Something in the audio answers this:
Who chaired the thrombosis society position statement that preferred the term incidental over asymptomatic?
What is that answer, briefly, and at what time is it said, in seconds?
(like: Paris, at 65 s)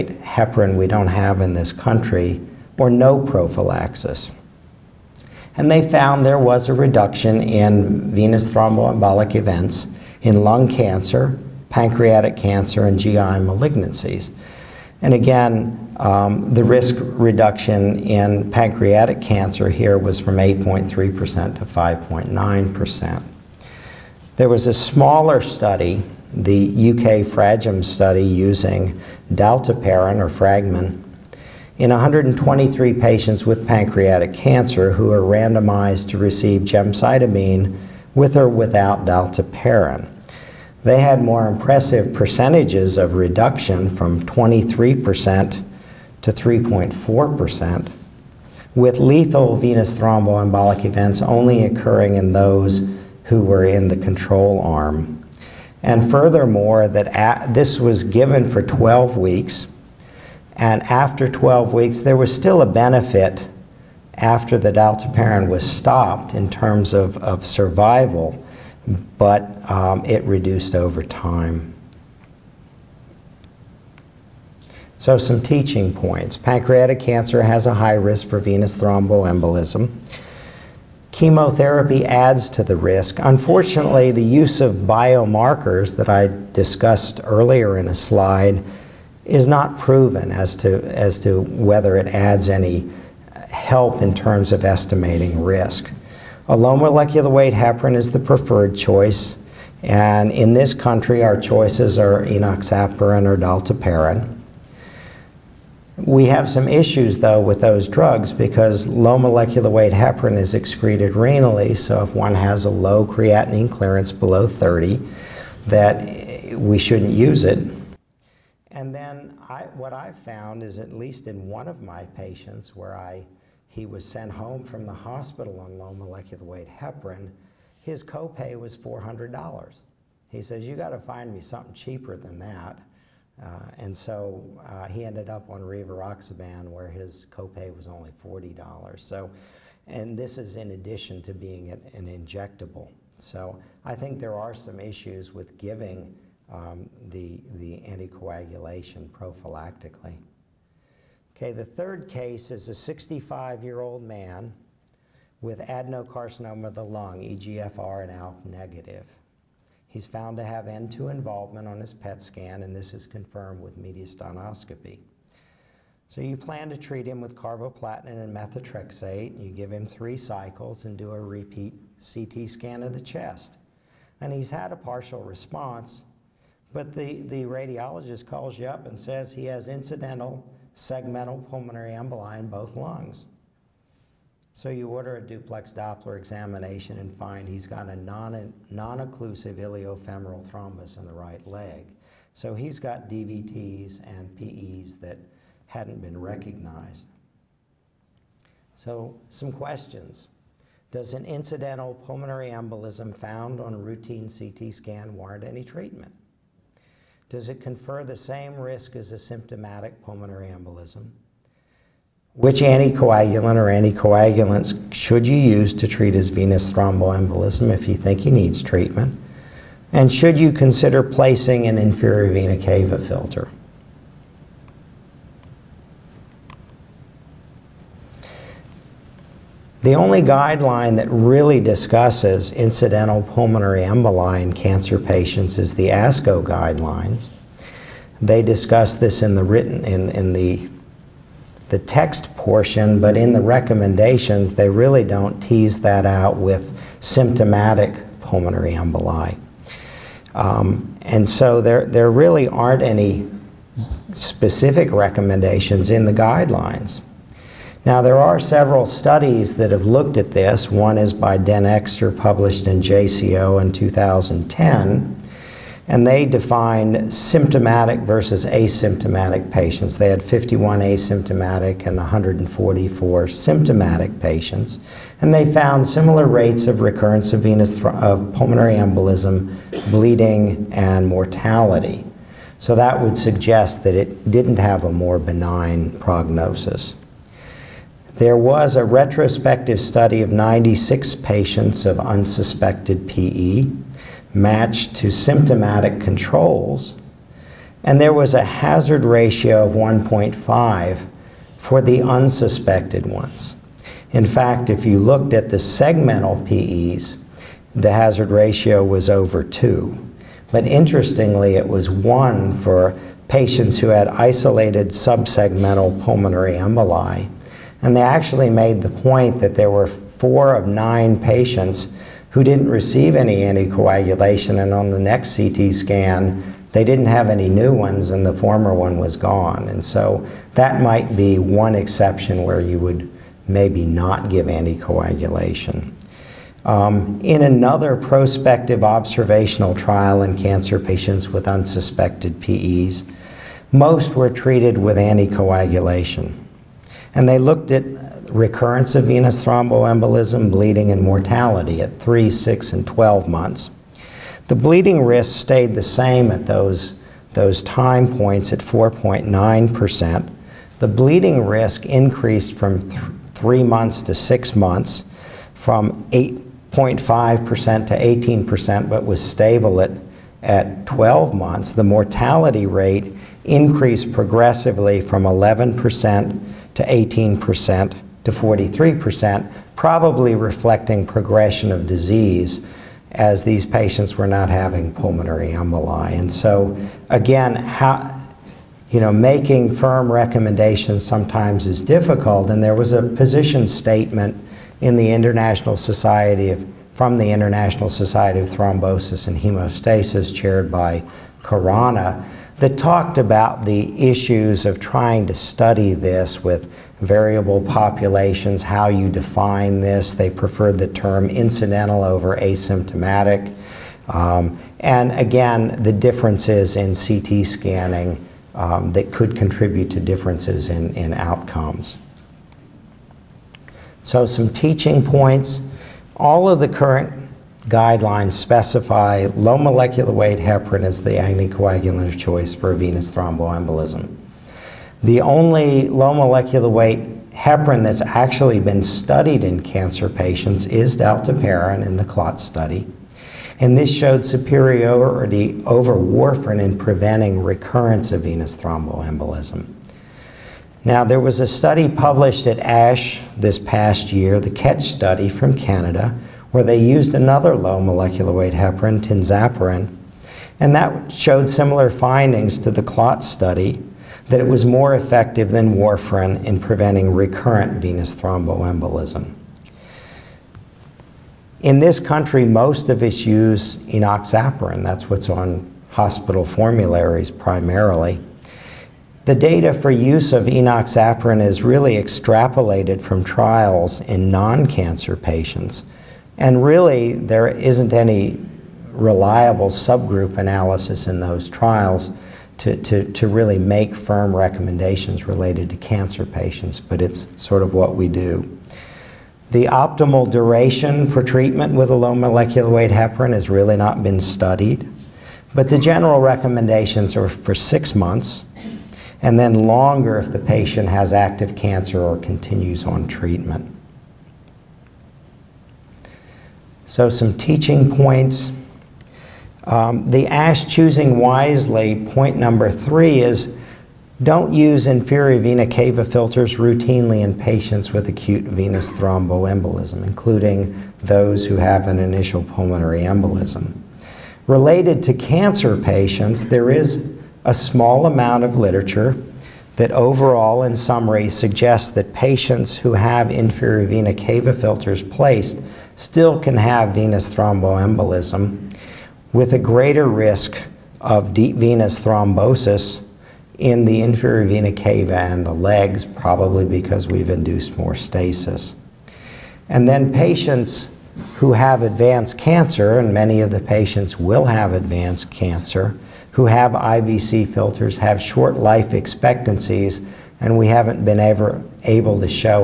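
Khorana, at 401 s.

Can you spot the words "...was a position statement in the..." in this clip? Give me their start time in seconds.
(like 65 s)
392 s.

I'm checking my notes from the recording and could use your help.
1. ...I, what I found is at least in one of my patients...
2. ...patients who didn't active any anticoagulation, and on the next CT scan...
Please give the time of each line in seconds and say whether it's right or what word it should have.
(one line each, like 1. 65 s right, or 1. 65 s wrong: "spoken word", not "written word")
1. 119 s right
2. 321 s wrong: "receive", not "active".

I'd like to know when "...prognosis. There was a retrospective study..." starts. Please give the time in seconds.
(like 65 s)
285 s.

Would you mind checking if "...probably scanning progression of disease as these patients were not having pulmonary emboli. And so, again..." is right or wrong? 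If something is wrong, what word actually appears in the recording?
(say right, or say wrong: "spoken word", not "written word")
wrong: "reflecting", not "scanning".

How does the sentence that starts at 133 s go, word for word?
Uh, and so uh, he ended up on rivaroxaban where his copay was only $40.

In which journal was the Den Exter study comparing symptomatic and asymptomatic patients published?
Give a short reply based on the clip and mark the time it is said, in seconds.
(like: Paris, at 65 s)
JCO, at 262 s.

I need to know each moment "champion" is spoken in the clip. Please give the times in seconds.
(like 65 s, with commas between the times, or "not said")
not said.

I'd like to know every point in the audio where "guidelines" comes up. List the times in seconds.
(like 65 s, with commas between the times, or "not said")
230 s, 236 s, 256 s, 427 s.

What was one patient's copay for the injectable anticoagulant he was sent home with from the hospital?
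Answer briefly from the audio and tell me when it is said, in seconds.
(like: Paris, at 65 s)
$400, at 128 s.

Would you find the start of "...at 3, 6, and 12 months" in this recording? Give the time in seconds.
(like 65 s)
351 s.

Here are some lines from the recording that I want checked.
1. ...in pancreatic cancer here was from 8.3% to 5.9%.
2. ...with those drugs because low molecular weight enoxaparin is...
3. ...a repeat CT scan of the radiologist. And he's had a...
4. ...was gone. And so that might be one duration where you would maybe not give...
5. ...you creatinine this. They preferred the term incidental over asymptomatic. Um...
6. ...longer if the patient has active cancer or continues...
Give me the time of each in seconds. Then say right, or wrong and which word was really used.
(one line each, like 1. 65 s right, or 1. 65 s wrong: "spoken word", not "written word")
1. 18 s right
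2. 107 s wrong: "heparin", not "enoxaparin"
3. 171 s wrong: "chest", not "radiologist"
4. 328 s wrong: "exception", not "duration"
5. 408 s wrong: "define", not "creatinine"
6. 509 s right.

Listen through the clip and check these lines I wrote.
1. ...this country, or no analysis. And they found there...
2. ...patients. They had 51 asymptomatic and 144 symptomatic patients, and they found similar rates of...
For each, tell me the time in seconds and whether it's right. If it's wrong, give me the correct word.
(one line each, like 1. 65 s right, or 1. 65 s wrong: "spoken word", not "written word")
1. 1 s wrong: "prophylaxis", not "analysis"
2. 269 s right.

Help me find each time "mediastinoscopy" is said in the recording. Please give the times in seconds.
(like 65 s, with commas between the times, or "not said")
163 s.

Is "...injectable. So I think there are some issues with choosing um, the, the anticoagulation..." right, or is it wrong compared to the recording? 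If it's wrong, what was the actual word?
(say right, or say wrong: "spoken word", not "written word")
wrong: "giving", not "choosing".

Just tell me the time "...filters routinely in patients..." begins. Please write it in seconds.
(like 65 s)
526 s.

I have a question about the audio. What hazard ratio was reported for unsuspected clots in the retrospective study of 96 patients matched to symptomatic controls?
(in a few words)
1.5.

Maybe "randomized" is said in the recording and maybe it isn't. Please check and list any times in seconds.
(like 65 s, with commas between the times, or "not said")
35 s.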